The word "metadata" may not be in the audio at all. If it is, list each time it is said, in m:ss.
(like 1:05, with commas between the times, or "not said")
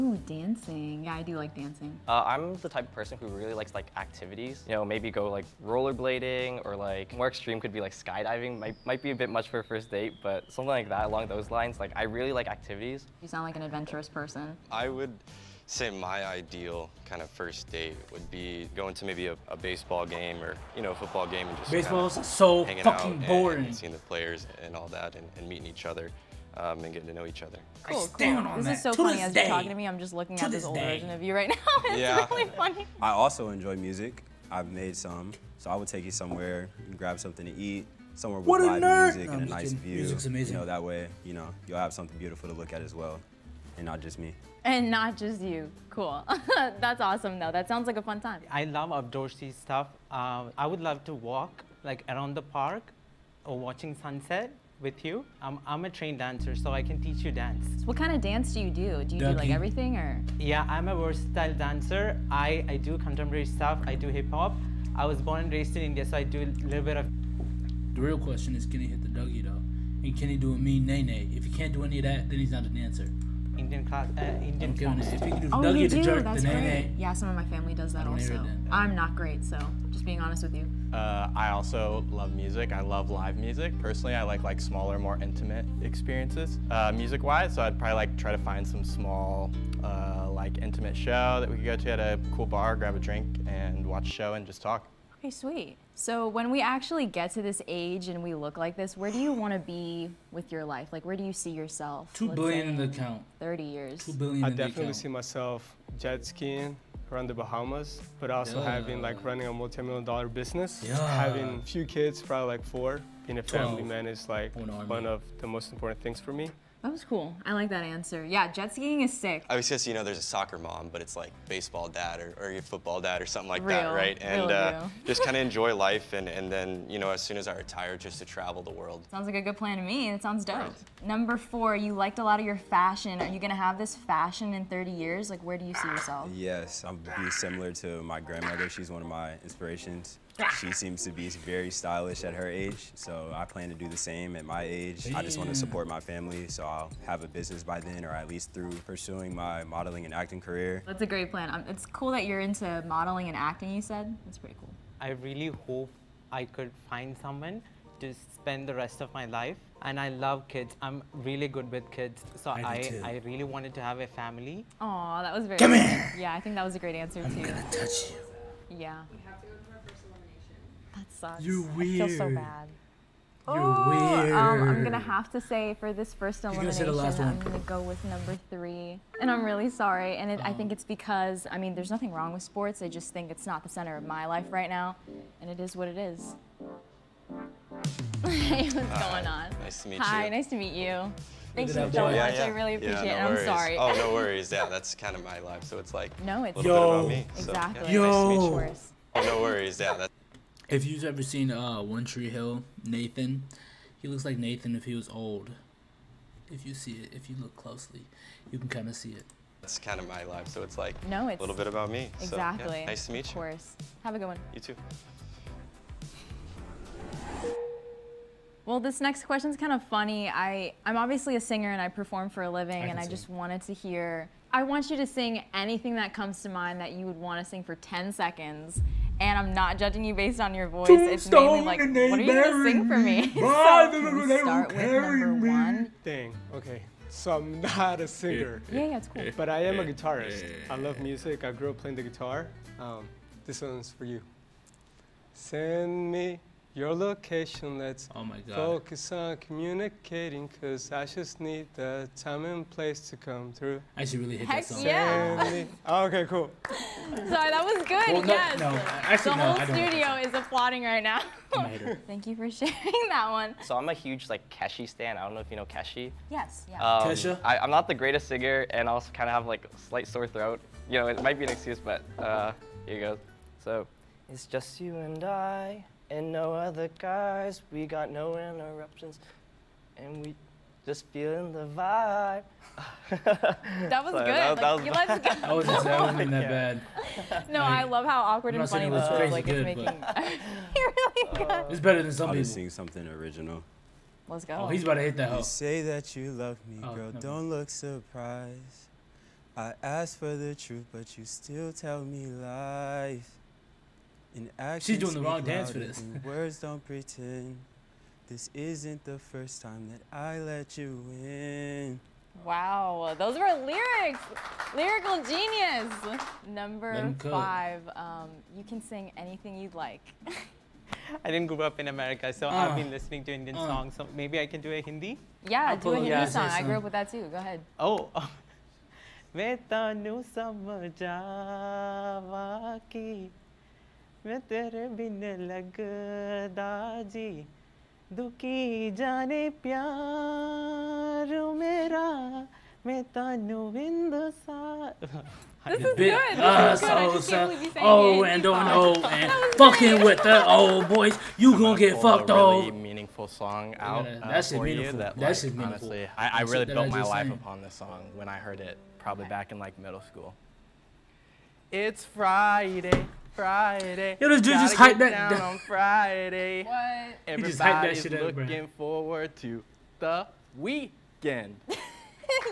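not said.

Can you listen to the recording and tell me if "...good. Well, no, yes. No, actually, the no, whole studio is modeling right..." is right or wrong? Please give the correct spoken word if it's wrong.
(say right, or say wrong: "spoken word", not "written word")
wrong: "applauding", not "modeling".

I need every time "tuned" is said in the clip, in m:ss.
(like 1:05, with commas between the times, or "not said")
not said.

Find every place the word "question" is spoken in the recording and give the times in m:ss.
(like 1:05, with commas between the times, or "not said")
1:08, 3:39.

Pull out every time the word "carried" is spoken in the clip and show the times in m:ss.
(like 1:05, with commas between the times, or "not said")
not said.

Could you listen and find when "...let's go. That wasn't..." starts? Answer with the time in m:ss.
4:44.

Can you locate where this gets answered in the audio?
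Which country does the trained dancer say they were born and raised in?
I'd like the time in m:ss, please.
1:05.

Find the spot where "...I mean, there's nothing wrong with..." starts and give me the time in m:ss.
3:01.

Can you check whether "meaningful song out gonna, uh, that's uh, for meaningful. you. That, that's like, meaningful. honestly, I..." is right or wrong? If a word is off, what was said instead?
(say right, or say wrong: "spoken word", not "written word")
right.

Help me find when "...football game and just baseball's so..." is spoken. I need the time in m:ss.
0:20.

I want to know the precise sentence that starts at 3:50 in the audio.
Tombstone it's mainly like, what are you gonna sing for me?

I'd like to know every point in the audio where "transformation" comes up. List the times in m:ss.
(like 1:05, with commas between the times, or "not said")
not said.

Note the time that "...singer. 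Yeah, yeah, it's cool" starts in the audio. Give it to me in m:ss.
3:58.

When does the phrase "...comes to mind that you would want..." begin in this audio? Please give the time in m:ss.
3:46.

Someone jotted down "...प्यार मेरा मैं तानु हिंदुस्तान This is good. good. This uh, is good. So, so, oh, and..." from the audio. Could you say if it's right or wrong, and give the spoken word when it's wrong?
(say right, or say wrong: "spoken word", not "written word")
right.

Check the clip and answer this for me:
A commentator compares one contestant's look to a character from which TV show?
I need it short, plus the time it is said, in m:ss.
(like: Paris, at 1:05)
One Tree Hill, at 3:21.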